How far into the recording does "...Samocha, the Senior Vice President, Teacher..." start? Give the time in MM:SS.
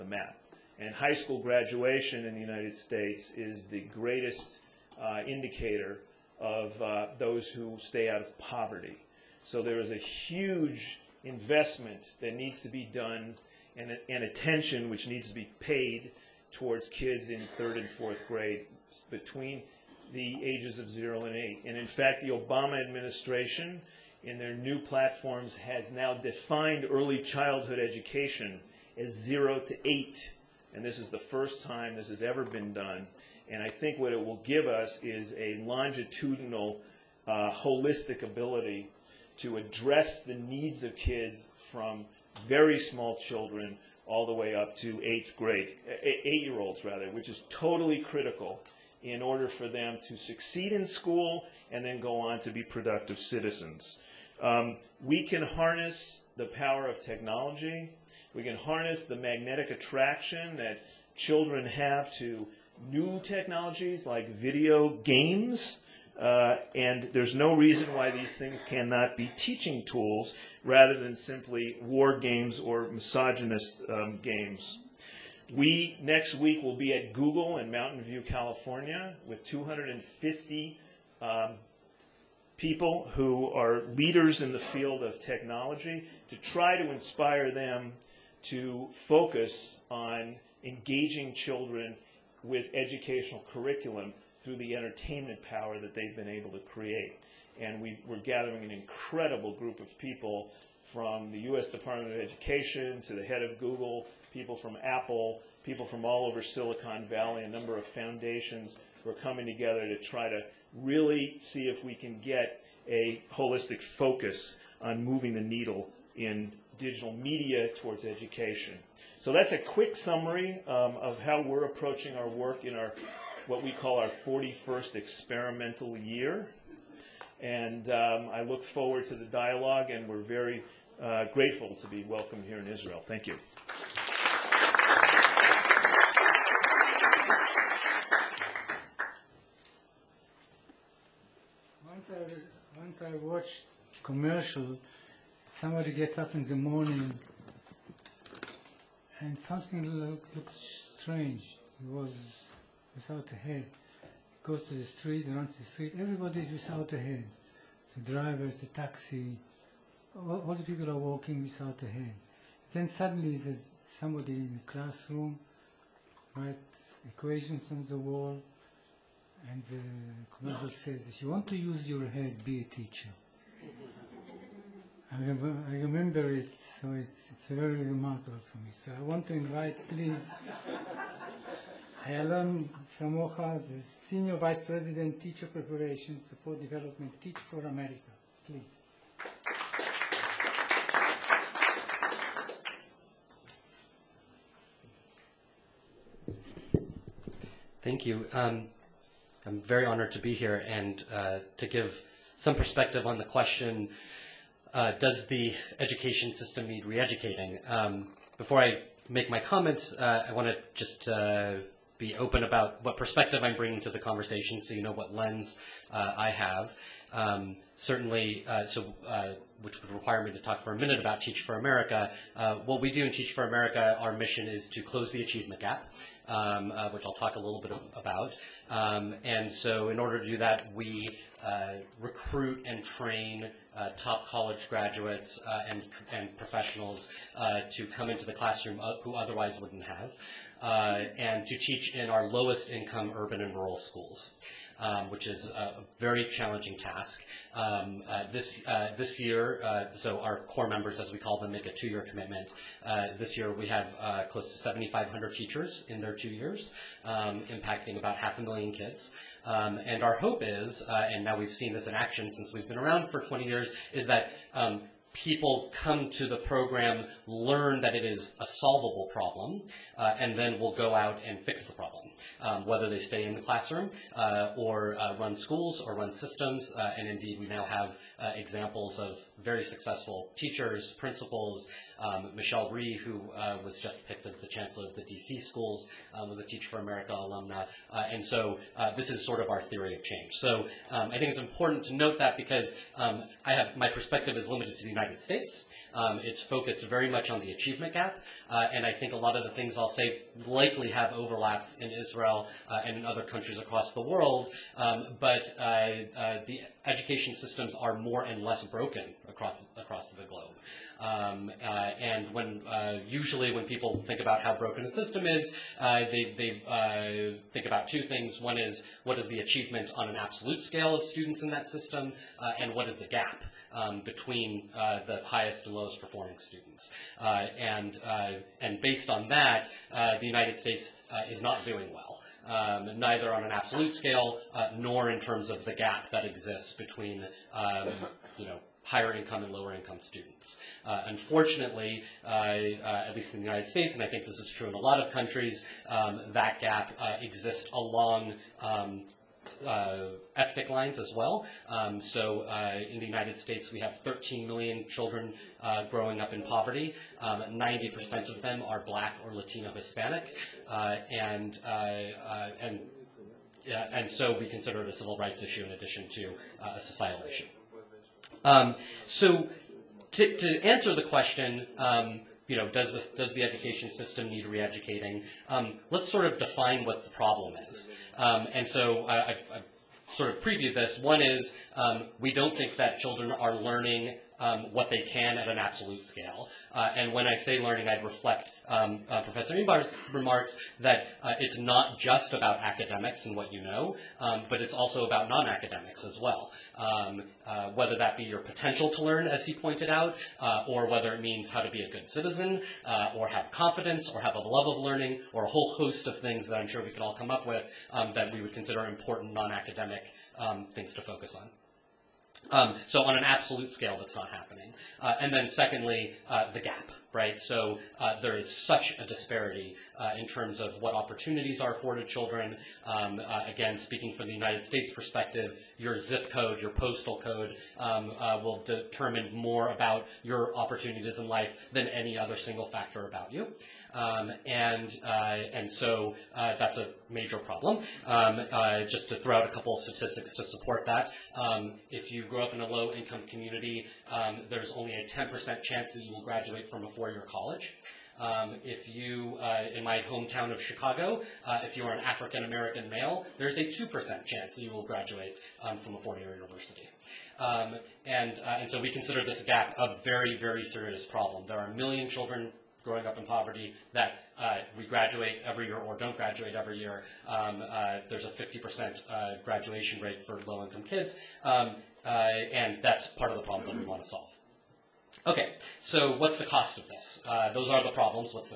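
03:02.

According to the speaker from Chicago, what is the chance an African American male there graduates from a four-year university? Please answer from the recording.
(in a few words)
2%.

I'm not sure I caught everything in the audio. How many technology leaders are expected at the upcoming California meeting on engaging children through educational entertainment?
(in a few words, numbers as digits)
250.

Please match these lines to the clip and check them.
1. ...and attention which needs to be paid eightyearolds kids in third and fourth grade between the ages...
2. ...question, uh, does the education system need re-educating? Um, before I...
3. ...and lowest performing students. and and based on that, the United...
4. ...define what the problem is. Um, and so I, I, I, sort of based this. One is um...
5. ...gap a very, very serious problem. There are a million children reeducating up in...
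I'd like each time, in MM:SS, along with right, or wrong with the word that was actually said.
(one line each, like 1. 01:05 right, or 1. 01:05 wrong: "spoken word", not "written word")
1. 00:14 wrong: "towards", not "eightyearolds"
2. 03:23 right
3. 05:25 right
4. 06:16 wrong: "previewed", not "based"
5. 07:39 wrong: "growing", not "reeducating".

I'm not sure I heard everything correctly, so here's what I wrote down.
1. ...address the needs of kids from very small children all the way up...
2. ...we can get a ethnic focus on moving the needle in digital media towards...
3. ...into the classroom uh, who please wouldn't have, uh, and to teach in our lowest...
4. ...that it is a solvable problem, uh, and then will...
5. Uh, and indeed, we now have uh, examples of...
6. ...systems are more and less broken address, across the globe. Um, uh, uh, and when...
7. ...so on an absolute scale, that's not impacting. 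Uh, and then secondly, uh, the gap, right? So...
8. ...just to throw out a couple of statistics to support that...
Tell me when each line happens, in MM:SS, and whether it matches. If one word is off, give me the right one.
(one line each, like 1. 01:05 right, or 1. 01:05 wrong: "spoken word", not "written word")
1. 00:39 right
2. 01:51 wrong: "holistic", not "ethnic"
3. 03:58 wrong: "otherwise", not "please"
4. 04:27 right
5. 04:36 right
6. 05:07 wrong: "across", not "address"
7. 06:52 wrong: "happening", not "impacting"
8. 07:18 right.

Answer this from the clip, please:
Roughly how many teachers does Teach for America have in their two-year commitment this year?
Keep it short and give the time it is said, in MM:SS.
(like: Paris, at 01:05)
7,500, at 04:14.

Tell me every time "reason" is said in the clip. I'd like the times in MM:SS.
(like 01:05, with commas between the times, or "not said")
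01:07.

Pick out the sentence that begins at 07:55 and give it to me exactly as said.
Okay, so what's the cost of this?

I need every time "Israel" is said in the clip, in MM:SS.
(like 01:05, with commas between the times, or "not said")
02:12, 05:01.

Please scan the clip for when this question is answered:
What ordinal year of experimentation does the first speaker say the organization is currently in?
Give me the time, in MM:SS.
02:04.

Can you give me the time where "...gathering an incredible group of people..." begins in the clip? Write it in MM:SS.
01:38.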